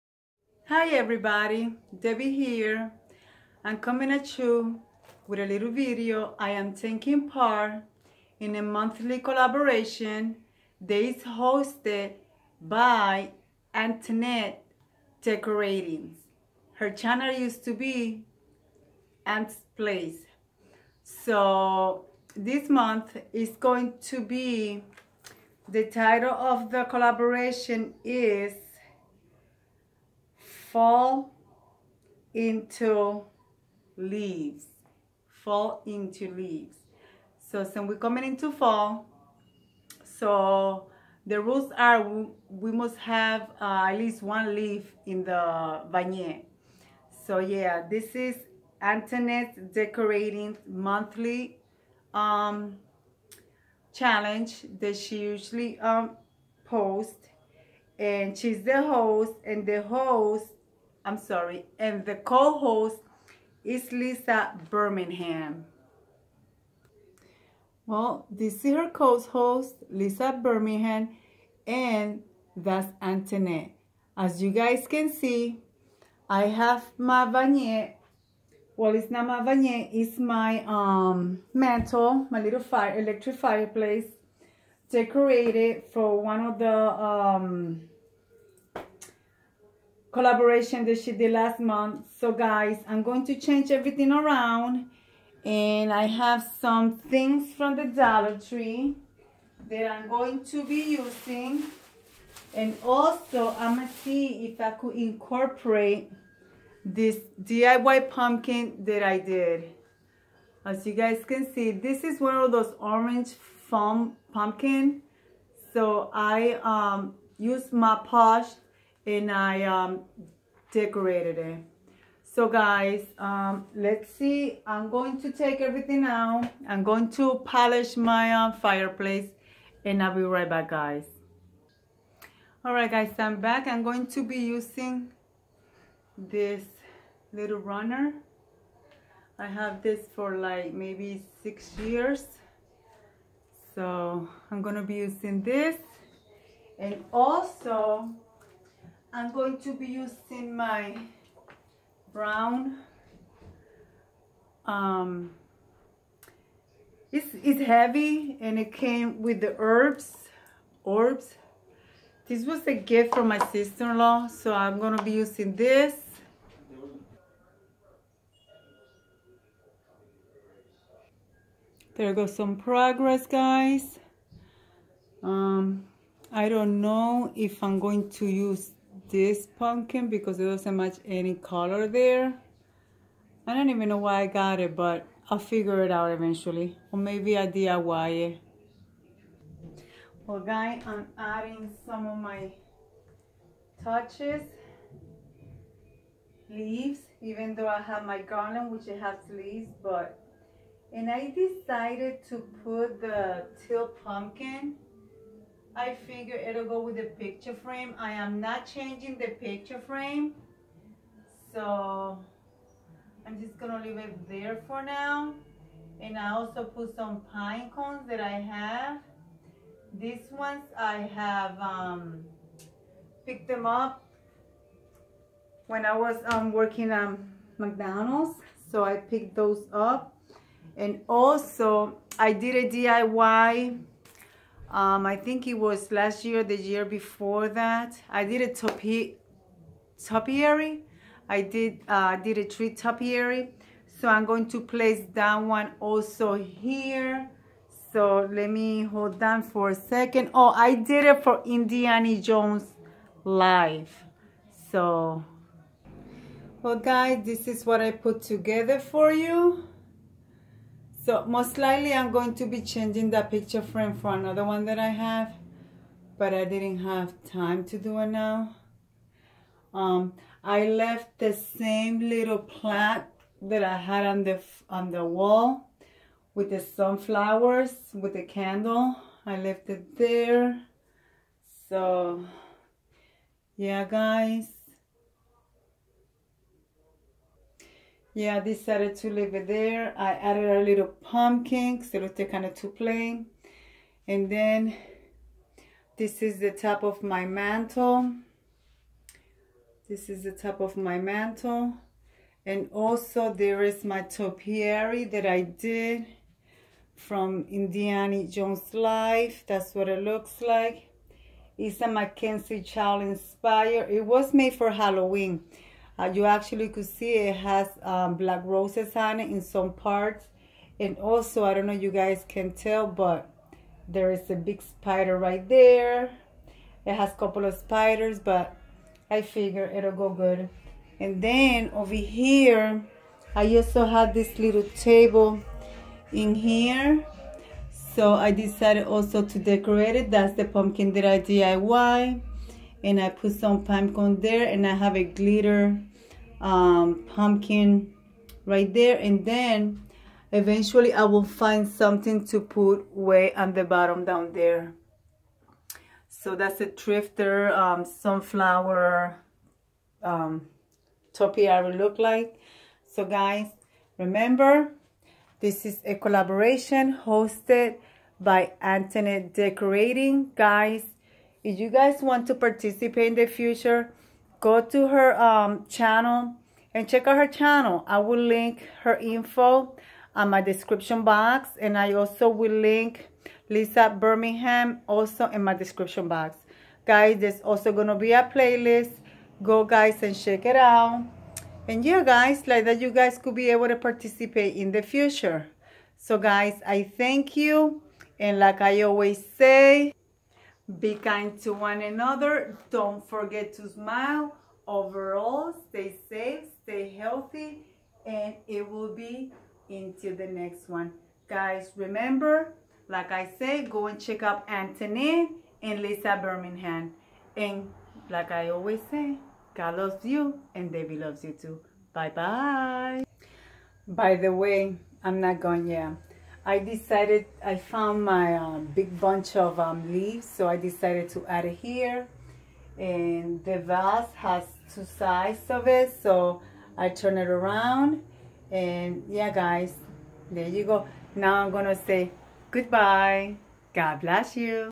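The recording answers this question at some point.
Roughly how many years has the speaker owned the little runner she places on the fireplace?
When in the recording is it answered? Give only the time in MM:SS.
02:21.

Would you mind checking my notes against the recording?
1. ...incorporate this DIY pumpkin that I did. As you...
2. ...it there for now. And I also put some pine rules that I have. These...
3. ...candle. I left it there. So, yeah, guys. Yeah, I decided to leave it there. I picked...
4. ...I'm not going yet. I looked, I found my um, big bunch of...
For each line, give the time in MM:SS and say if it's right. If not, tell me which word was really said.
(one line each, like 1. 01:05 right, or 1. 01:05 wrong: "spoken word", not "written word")
1. 01:44 right
2. 03:33 wrong: "cones", not "rules"
3. 04:38 wrong: "added", not "picked"
4. 07:05 wrong: "decided", not "looked".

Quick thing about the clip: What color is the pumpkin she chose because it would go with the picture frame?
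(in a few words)
Teal.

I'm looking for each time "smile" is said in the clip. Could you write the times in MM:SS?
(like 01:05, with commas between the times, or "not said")
06:43.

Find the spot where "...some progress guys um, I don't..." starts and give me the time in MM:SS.
02:52.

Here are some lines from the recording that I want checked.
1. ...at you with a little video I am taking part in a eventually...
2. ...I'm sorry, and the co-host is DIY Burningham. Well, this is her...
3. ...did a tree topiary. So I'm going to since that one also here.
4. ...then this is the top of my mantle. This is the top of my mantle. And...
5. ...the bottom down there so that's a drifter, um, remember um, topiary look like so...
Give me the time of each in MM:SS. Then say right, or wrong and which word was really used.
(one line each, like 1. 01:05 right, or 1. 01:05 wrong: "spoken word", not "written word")
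1. 00:04 wrong: "monthly", not "eventually"
2. 01:01 wrong: "Lisa", not "DIY"
3. 04:02 wrong: "place", not "since"
4. 04:54 right
5. 05:53 wrong: "sunflower", not "remember".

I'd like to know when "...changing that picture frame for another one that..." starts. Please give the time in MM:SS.
04:22.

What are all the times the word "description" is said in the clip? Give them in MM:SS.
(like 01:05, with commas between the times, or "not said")
06:20, 06:25.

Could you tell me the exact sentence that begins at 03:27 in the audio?
I am not changing the picture frame.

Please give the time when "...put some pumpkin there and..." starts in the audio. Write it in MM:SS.
05:43.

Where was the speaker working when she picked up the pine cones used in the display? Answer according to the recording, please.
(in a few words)
McDonald's.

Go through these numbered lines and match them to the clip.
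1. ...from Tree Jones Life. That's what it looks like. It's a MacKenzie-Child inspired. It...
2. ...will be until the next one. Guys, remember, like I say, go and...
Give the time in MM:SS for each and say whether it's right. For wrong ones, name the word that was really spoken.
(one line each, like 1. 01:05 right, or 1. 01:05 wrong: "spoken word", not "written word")
1. 05:06 wrong: "Indiana", not "Tree"
2. 06:48 right.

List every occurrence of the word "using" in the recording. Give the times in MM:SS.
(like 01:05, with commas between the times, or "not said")
01:40, 02:14, 02:24, 02:29, 02:45.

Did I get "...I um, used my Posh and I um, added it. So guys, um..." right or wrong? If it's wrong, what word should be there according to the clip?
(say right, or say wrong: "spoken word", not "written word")
wrong: "decorated", not "added".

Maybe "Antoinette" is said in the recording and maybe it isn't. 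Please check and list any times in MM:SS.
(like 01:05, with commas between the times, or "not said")
00:13, 00:48, 01:13, 06:08.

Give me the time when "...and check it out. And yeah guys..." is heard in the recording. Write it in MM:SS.
06:30.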